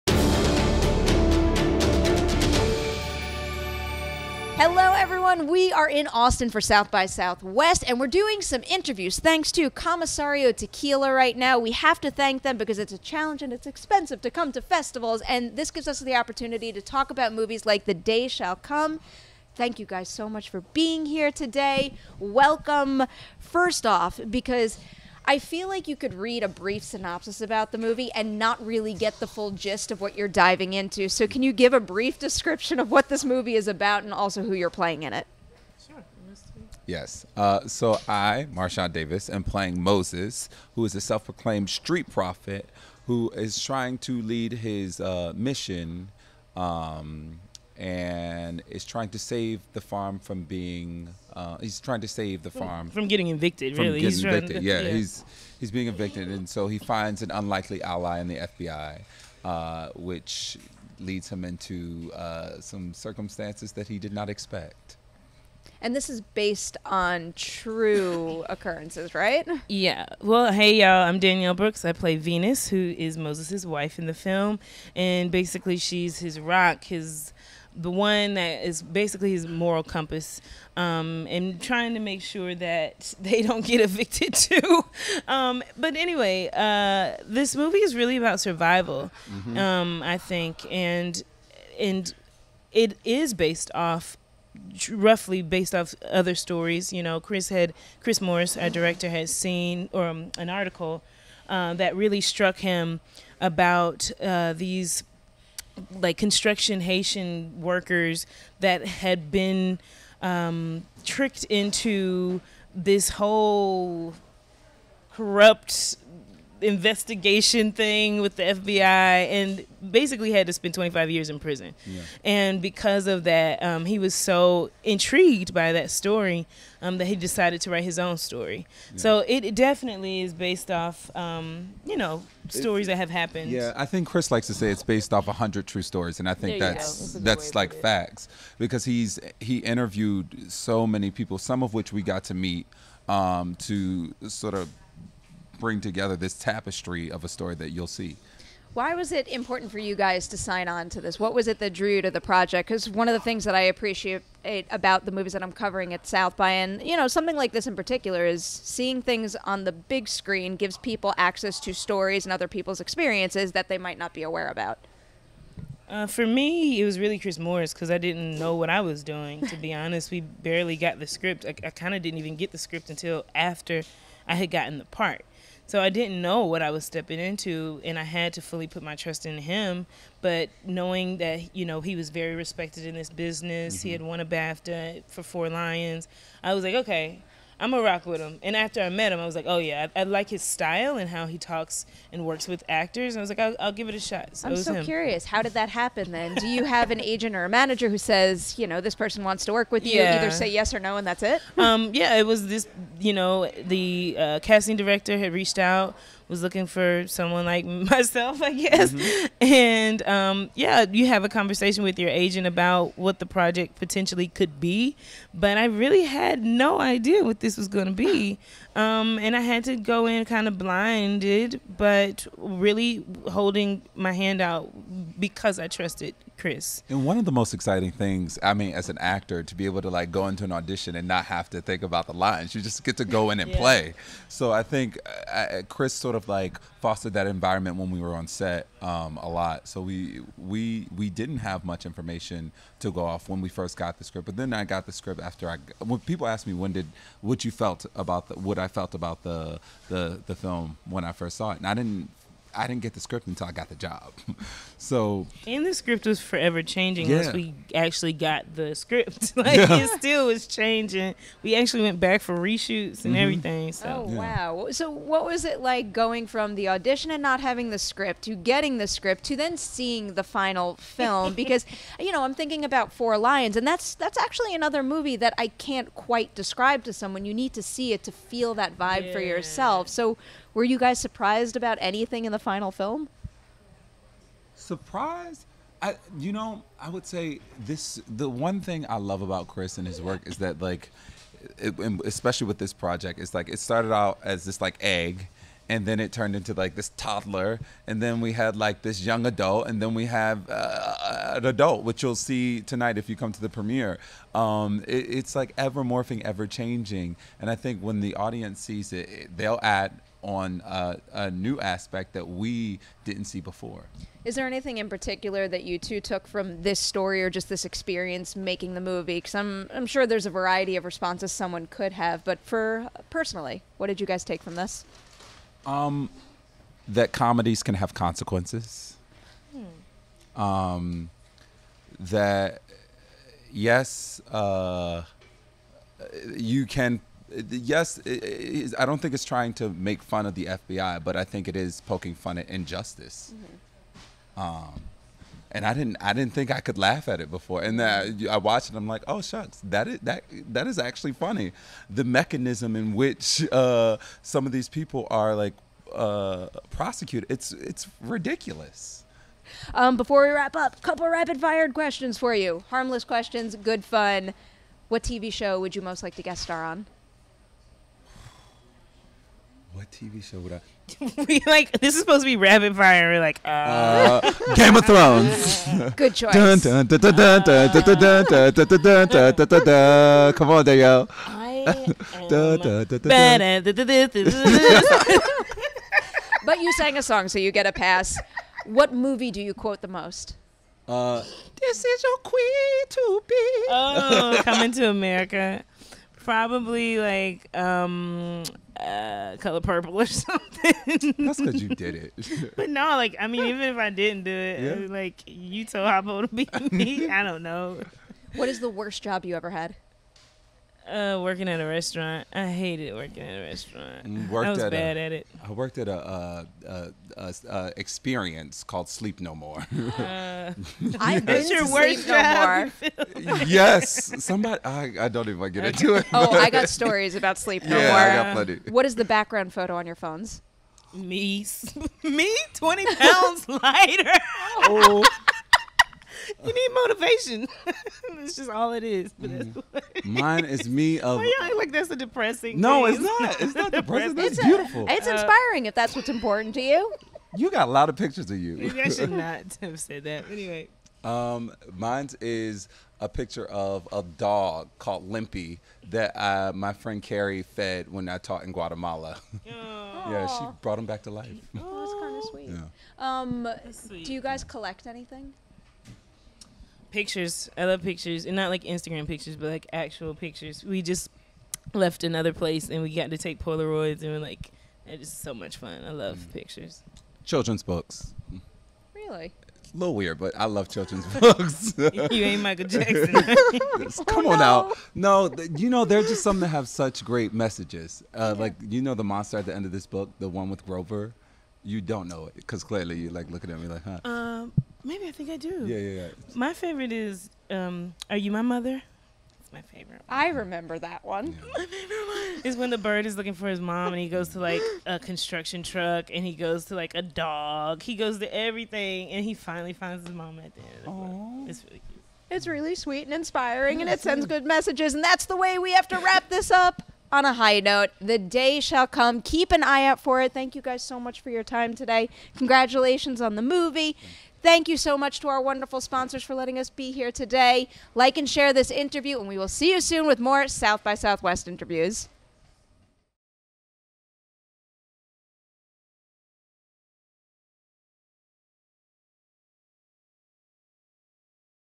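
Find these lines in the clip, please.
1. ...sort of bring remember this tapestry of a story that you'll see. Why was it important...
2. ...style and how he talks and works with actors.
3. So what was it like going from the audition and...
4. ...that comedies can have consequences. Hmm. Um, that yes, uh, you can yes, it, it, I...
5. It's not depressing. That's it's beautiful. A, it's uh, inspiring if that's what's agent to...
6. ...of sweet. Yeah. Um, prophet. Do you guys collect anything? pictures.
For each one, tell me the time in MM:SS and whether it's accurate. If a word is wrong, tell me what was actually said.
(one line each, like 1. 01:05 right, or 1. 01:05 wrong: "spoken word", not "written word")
1. 02:24 wrong: "together", not "remember"
2. 03:10 right
3. 04:24 right
4. 05:26 right
5. 07:23 wrong: "important", not "agent"
6. 07:42 wrong: "sweet", not "prophet".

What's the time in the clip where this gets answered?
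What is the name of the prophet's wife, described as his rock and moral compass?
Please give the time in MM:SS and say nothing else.
01:12.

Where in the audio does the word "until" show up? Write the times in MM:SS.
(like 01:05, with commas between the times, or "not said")
02:52, 04:13.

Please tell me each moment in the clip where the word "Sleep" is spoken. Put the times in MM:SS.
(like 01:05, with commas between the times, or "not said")
06:58, 07:07.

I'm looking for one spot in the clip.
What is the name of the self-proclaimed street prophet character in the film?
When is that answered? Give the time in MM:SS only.
00:39.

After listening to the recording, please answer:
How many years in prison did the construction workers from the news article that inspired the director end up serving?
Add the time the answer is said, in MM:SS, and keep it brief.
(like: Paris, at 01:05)
25, at 02:00.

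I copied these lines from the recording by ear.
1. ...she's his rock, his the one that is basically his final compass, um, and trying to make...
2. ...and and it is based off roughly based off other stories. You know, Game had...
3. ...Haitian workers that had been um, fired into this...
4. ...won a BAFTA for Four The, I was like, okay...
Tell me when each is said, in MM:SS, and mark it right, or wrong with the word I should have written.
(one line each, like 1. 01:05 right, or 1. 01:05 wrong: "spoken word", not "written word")
1. 01:15 wrong: "moral", not "final"
2. 01:30 wrong: "Chris", not "Game"
3. 01:46 wrong: "tricked", not "fired"
4. 03:04 wrong: "Lions", not "The".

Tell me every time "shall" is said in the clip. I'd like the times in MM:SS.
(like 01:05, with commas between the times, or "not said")
00:18, 08:38.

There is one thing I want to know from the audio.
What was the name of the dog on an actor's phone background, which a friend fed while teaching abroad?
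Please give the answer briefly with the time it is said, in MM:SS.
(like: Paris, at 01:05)
Limpy, at 07:35.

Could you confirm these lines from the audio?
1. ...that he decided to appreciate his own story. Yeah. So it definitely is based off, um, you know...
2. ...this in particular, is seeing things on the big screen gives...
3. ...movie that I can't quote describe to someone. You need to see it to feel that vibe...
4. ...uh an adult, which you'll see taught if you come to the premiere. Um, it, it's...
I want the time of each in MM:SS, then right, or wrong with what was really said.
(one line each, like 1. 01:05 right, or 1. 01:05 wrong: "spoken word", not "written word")
1. 02:06 wrong: "write", not "appreciate"
2. 02:37 right
3. 04:34 wrong: "quite", not "quote"
4. 05:00 wrong: "tonight", not "taught".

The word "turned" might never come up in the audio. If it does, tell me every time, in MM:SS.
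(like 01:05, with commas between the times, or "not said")
04:56.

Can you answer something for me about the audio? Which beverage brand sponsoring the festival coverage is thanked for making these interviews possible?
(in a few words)
Commissario Tequila.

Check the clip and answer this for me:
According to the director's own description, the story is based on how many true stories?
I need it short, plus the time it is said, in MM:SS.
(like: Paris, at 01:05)
100, at 02:15.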